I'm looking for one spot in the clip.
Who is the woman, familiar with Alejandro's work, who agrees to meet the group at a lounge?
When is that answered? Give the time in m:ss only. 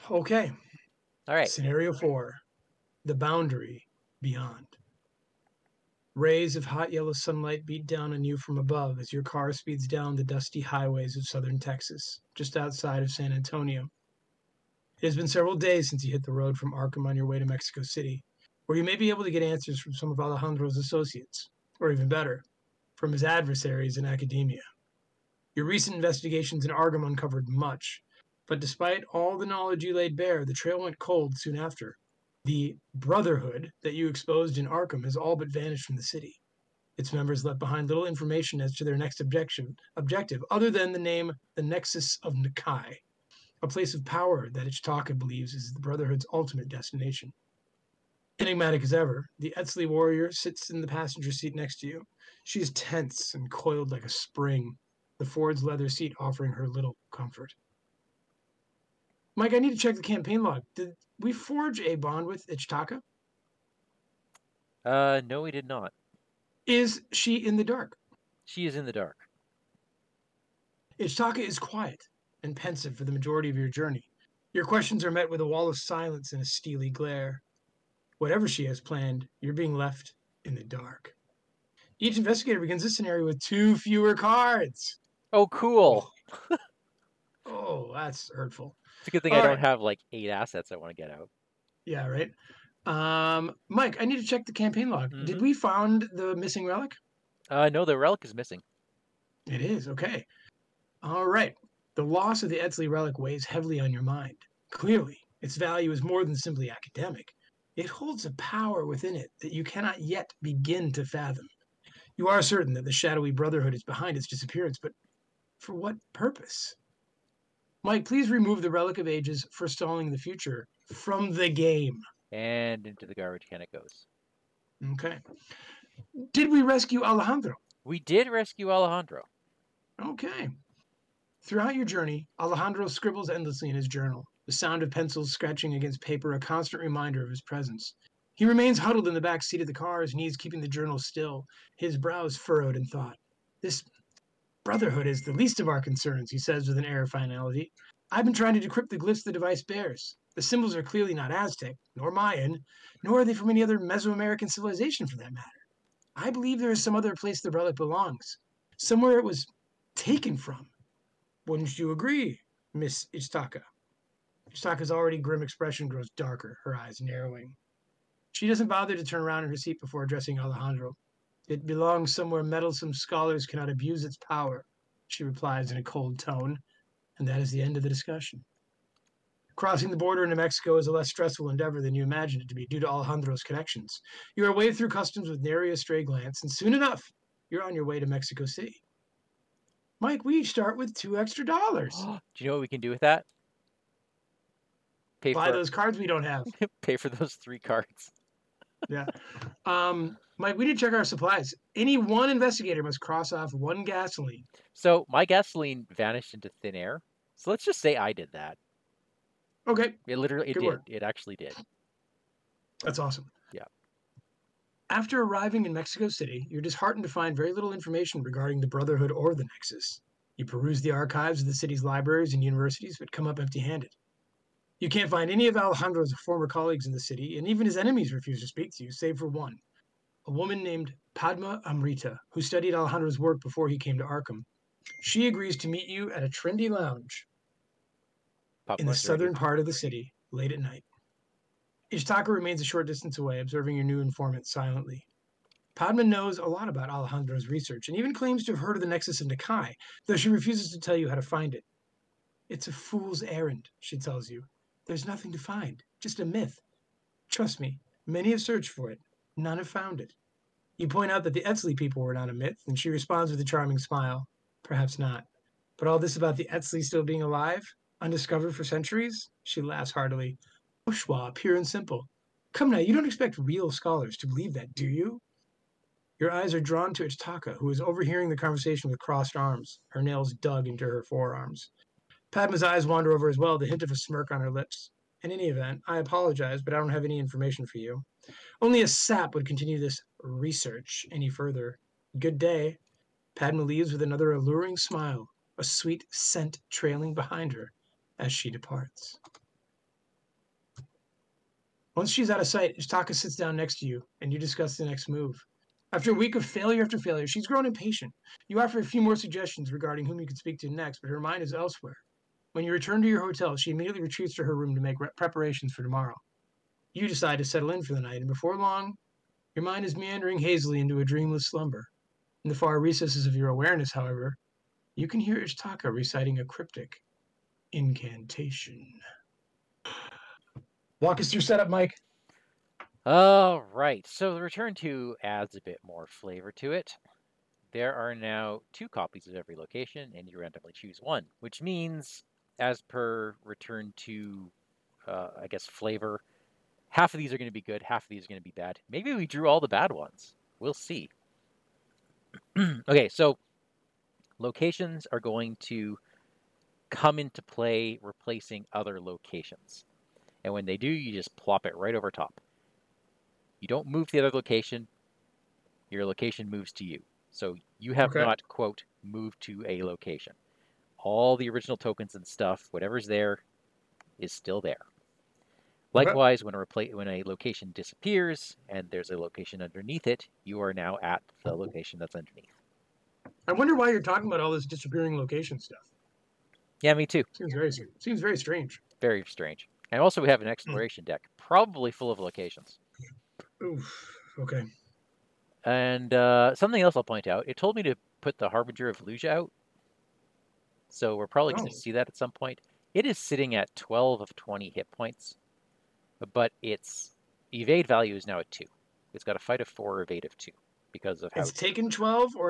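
3:51.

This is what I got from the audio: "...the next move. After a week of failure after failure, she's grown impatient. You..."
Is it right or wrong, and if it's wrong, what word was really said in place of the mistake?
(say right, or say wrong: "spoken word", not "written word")
right.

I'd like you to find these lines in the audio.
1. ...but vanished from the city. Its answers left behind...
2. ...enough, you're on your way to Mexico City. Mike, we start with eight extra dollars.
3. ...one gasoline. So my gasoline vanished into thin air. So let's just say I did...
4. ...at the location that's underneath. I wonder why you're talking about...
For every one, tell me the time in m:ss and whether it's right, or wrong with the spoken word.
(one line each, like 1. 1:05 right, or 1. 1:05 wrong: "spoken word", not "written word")
1. 0:35 wrong: "members", not "answers"
2. 3:06 wrong: "two", not "eight"
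3. 3:23 right
4. 6:21 right.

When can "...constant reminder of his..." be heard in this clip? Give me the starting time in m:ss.
2:16.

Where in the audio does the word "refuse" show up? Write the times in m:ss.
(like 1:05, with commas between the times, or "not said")
3:48, 4:10.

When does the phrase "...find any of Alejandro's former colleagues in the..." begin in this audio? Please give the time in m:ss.
3:45.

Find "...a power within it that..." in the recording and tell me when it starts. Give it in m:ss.
1:48.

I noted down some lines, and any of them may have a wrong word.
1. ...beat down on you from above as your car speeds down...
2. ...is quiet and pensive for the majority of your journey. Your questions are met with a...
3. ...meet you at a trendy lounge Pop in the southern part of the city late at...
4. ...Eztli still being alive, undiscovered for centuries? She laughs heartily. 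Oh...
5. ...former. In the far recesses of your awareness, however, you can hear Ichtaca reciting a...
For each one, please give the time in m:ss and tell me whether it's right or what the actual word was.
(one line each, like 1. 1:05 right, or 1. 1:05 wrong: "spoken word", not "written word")
1. 0:07 right
2. 1:11 right
3. 3:55 right
4. 4:26 right
5. 5:21 wrong: "slumber", not "former".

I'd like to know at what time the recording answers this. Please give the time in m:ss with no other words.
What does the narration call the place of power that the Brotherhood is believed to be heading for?
0:41.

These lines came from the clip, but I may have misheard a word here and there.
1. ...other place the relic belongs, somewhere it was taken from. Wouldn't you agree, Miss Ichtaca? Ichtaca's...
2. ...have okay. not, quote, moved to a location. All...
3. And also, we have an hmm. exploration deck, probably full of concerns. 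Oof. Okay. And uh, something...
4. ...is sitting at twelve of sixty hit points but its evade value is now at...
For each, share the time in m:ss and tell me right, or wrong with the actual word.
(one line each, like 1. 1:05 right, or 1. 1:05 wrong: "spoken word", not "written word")
1. 2:36 right
2. 6:07 right
3. 6:29 wrong: "locations", not "concerns"
4. 6:43 wrong: "twenty", not "sixty".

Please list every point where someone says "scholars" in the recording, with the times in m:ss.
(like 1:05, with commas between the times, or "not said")
2:52, 4:33.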